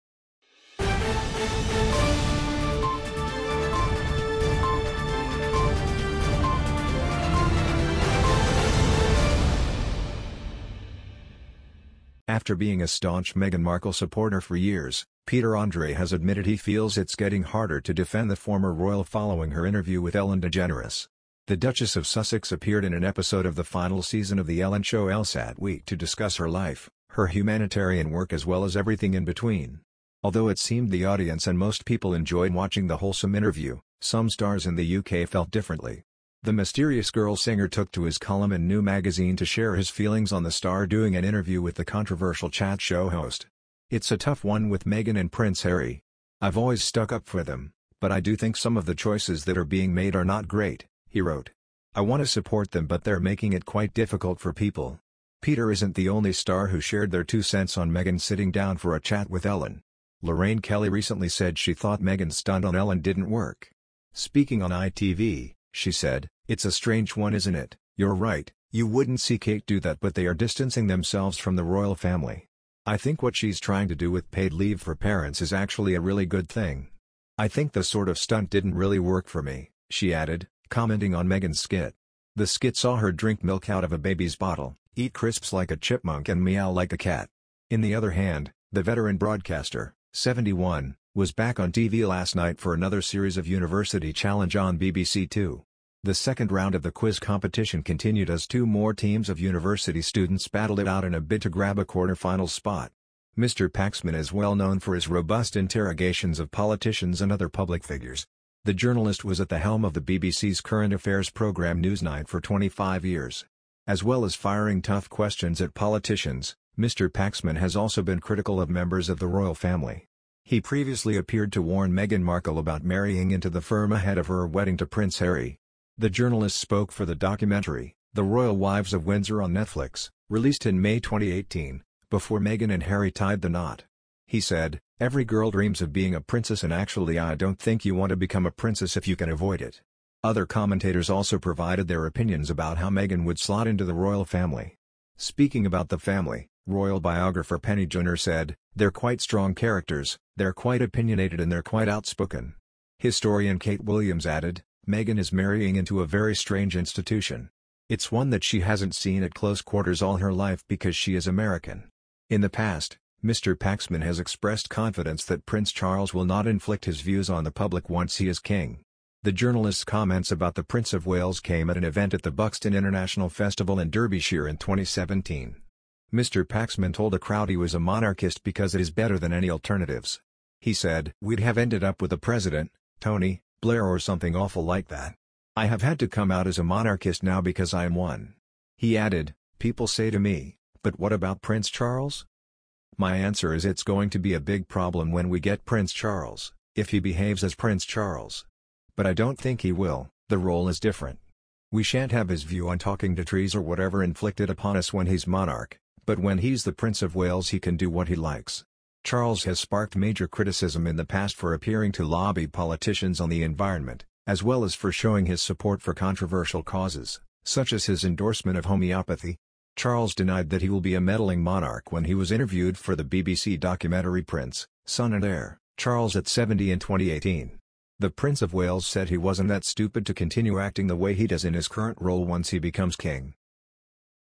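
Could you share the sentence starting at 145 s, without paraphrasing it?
Speaking about the family, royal biographer Penny Junor said, they're quite strong characters, they're quite opinionated and they're quite outspoken.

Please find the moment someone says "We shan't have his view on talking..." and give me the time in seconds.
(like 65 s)
201 s.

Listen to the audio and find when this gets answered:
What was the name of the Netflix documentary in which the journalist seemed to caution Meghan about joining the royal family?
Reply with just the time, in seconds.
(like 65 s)
128 s.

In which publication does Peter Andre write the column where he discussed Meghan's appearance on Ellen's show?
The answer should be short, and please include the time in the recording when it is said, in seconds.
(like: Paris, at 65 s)
New Magazine, at 38 s.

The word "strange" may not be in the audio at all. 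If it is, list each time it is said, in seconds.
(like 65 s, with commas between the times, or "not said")
66 s, 156 s.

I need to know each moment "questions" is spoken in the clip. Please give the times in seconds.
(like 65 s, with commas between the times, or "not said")
115 s.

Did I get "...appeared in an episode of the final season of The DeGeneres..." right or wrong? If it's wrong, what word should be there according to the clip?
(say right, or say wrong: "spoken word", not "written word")
wrong: "Ellen", not "DeGeneres".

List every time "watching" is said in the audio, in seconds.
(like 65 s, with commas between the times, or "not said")
32 s.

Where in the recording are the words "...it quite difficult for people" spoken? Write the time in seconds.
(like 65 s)
53 s.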